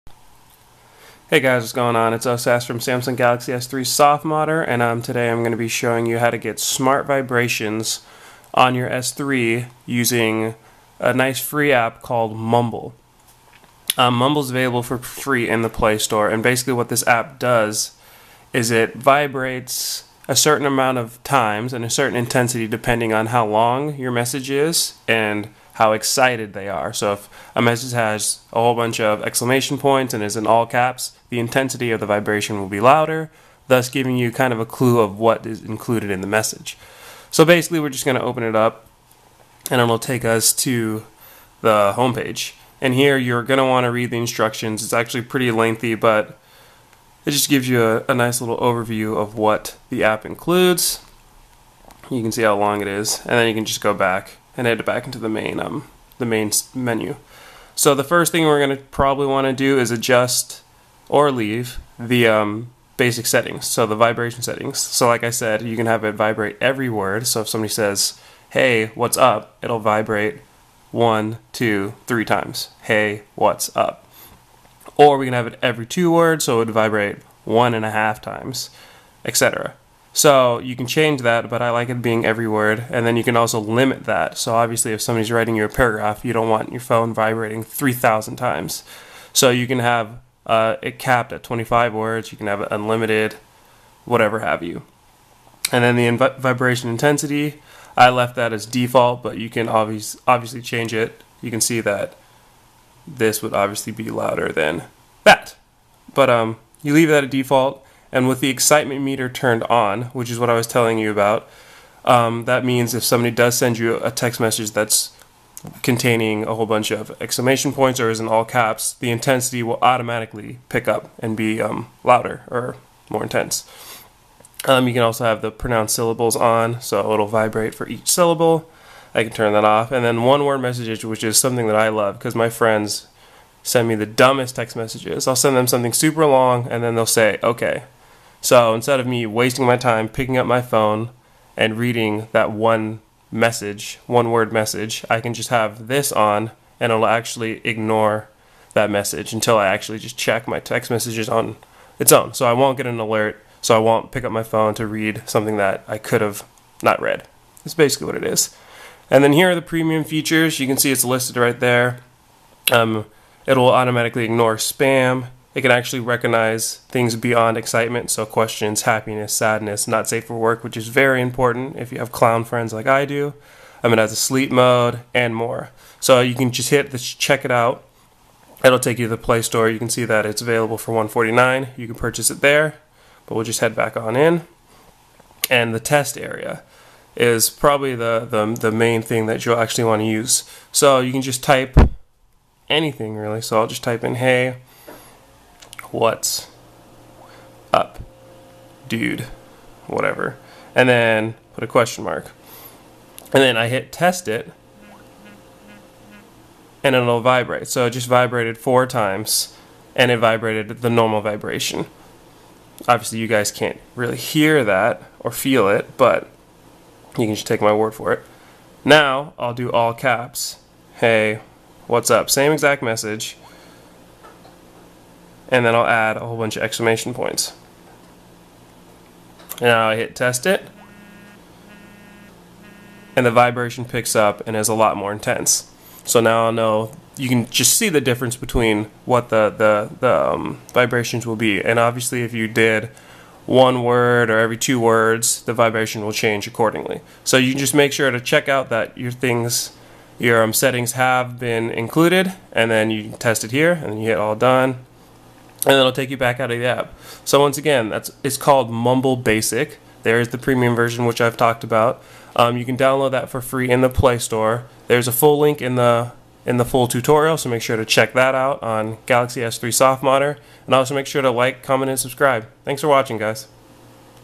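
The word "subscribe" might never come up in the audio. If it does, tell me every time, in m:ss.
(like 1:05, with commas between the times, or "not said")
4:31.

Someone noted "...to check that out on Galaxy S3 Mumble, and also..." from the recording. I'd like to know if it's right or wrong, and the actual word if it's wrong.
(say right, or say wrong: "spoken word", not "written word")
wrong: "Softmodder", not "Mumble".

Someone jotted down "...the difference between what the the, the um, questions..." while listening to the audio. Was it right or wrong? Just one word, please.
wrong.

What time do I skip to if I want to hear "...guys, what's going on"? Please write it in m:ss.
0:01.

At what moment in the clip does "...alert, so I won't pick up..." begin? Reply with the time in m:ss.
2:32.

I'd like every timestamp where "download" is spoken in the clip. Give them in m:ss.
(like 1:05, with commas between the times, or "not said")
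4:22.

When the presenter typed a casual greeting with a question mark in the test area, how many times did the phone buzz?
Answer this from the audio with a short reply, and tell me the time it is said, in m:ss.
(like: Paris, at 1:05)
4 times, at 3:28.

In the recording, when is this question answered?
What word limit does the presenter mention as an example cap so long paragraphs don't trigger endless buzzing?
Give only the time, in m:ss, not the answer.
1:30.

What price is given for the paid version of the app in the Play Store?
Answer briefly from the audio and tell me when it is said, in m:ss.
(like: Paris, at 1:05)
1.49, at 3:00.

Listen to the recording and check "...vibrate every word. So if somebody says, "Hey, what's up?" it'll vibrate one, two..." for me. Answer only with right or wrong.
right.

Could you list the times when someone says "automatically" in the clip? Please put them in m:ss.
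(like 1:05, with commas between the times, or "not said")
1:59, 2:43.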